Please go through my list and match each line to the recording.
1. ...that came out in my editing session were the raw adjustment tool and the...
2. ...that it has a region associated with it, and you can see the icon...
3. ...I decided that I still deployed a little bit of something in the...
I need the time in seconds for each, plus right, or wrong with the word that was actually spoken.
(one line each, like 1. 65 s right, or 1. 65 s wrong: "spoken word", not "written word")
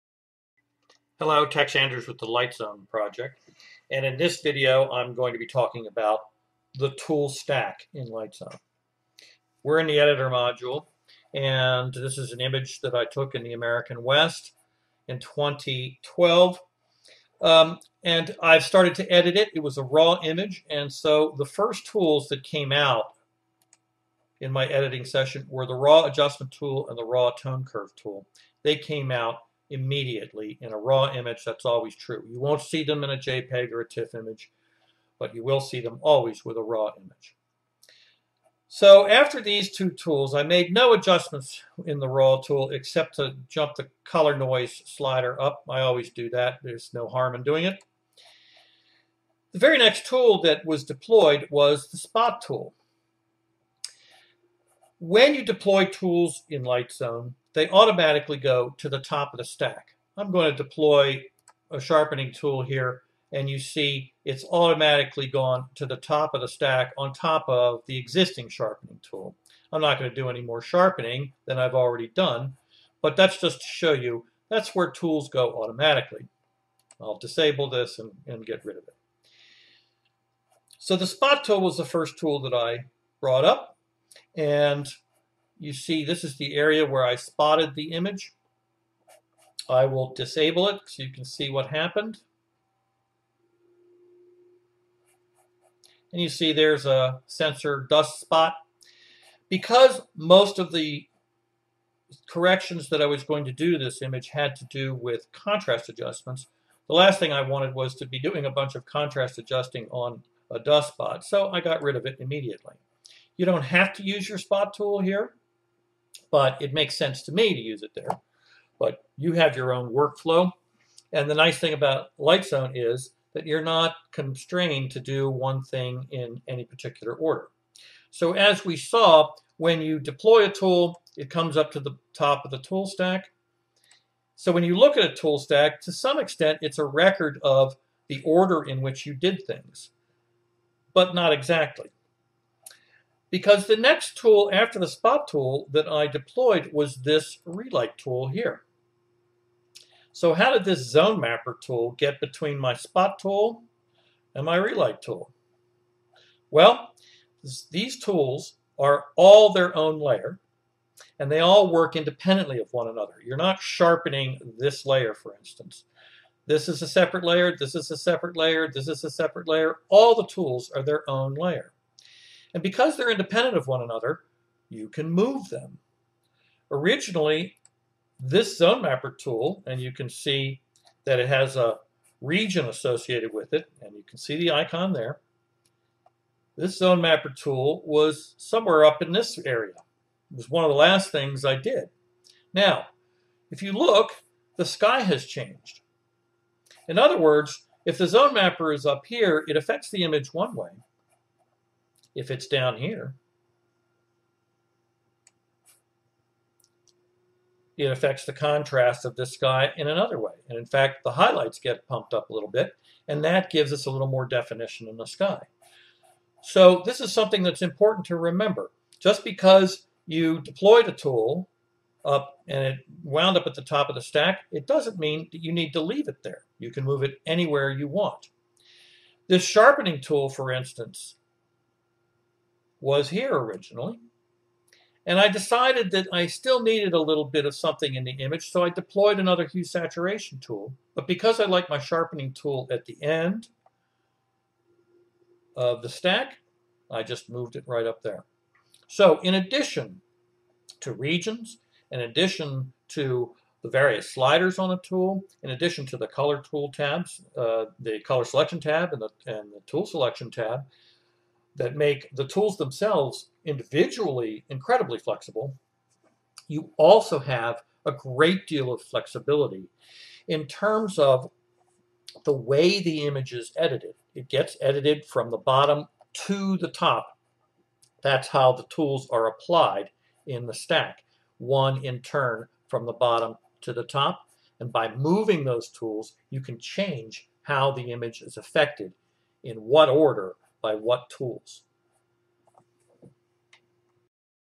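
1. 22 s right
2. 181 s right
3. 235 s wrong: "needed", not "deployed".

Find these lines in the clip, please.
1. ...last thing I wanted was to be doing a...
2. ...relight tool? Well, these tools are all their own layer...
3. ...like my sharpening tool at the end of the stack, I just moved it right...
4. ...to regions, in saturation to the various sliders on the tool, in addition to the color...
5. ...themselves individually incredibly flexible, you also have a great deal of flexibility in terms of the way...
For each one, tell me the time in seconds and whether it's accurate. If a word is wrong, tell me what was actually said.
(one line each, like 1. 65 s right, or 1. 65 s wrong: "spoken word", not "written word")
1. 106 s right
2. 154 s right
3. 241 s right
4. 250 s wrong: "addition", not "saturation"
5. 262 s right.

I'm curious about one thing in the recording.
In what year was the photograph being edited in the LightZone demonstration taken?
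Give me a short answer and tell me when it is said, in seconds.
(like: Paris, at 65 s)
2012, at 15 s.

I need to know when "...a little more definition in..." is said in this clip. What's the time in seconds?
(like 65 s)
213 s.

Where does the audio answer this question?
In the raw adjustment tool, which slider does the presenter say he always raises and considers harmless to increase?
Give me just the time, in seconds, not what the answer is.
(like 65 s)
44 s.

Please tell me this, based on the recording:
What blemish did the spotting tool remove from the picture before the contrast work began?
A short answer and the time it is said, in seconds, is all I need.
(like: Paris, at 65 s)
sensor dust spot, at 97 s.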